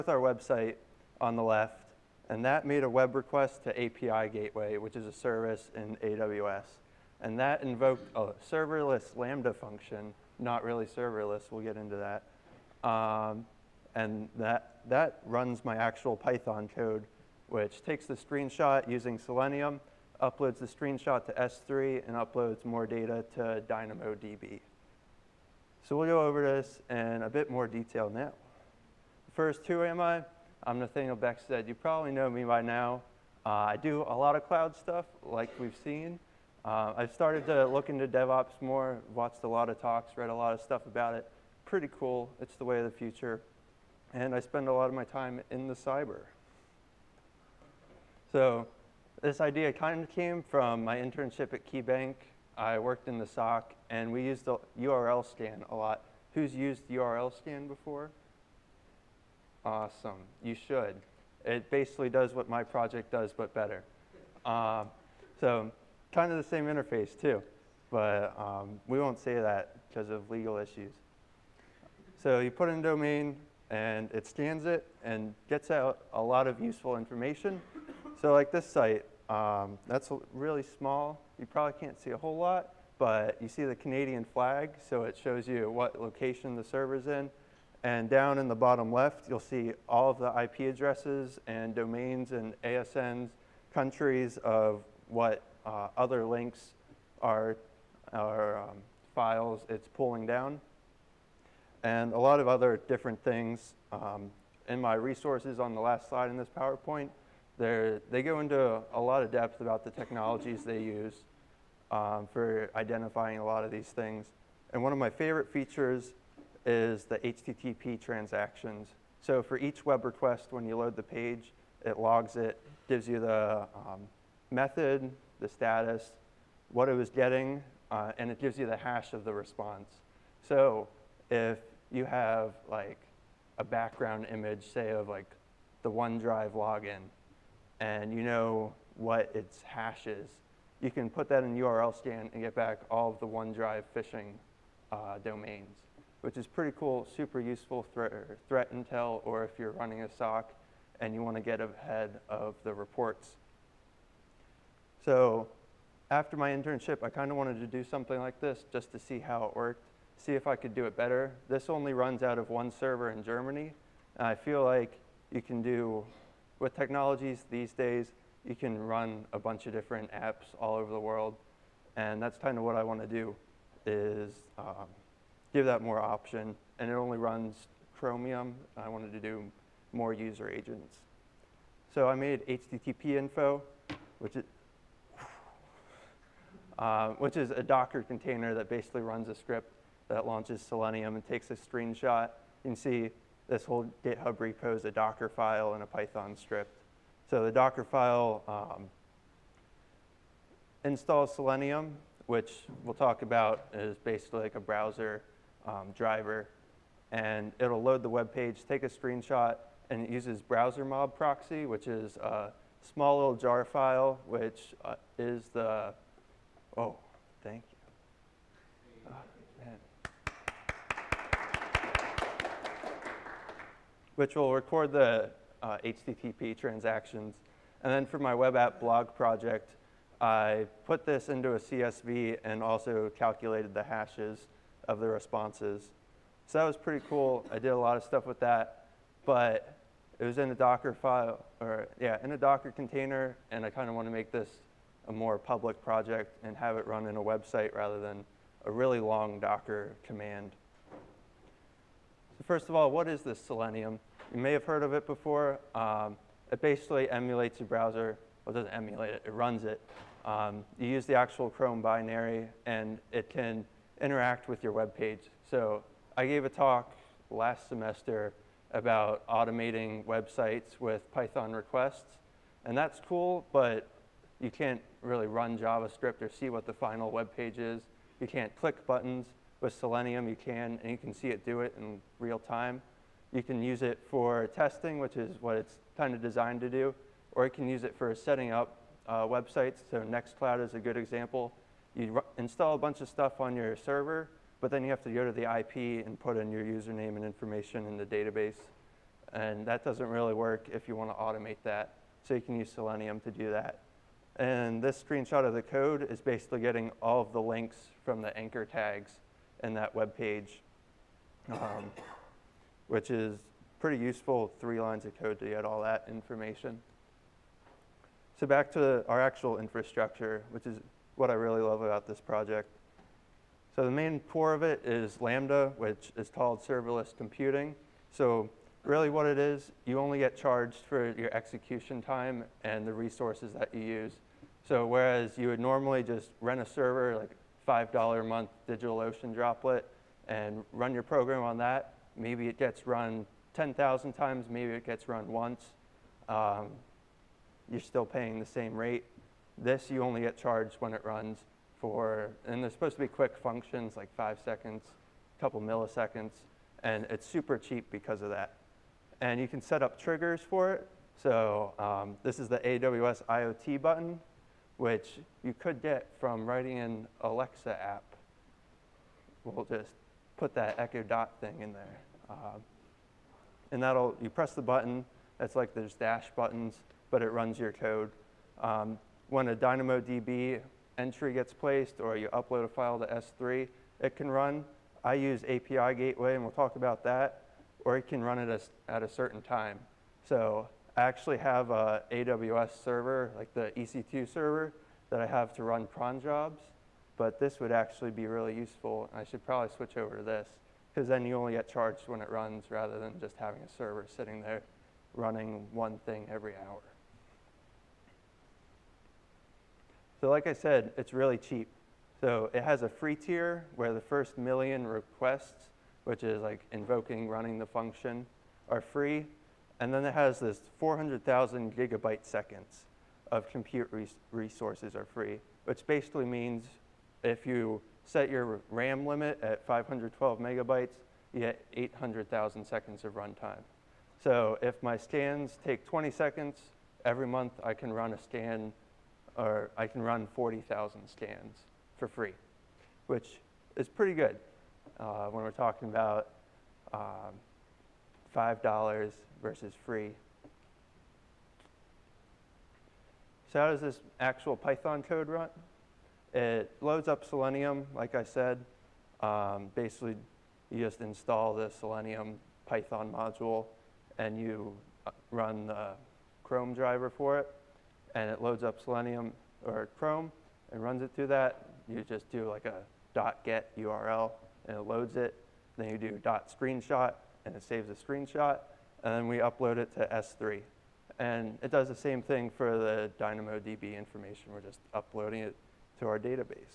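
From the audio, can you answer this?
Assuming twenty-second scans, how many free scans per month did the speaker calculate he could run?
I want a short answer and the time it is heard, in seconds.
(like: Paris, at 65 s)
40,000, at 440 s.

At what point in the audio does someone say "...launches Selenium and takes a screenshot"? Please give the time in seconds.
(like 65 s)
190 s.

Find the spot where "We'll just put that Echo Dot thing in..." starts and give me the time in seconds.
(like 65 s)
369 s.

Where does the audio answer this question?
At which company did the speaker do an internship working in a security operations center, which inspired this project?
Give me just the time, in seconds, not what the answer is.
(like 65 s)
51 s.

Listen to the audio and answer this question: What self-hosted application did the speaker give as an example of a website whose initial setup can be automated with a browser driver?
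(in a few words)
Nextcloud.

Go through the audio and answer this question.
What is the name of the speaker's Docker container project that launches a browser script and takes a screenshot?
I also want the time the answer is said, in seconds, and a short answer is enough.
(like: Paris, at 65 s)
HTTP info, at 182 s.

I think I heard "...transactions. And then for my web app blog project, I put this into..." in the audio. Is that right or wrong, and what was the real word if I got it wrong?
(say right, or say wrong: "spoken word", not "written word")
right.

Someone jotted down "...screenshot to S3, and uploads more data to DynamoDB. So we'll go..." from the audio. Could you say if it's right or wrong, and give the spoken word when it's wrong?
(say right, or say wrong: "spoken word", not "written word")
right.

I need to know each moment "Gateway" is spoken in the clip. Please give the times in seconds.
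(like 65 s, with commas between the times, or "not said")
4 s, 385 s.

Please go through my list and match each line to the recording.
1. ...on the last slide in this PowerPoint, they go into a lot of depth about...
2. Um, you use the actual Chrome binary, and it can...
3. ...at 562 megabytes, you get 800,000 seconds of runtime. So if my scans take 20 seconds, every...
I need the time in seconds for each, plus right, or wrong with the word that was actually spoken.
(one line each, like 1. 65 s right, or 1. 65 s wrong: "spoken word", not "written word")
1. 105 s right
2. 260 s right
3. 429 s wrong: "512", not "562".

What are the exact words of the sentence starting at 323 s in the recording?
So the main core of it is Lambda, which is called serverless computing.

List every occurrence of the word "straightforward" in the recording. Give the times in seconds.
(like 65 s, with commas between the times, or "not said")
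not said.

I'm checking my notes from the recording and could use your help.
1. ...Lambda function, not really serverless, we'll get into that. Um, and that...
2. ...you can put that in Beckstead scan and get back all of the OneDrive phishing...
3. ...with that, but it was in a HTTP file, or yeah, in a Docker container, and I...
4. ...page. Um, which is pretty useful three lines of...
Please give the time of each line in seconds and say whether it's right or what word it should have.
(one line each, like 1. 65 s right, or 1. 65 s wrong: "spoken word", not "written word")
1. 9 s right
2. 140 s wrong: "URL", not "Beckstead"
3. 238 s wrong: "Docker", not "HTTP"
4. 310 s right.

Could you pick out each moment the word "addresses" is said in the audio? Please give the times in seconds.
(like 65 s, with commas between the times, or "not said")
90 s.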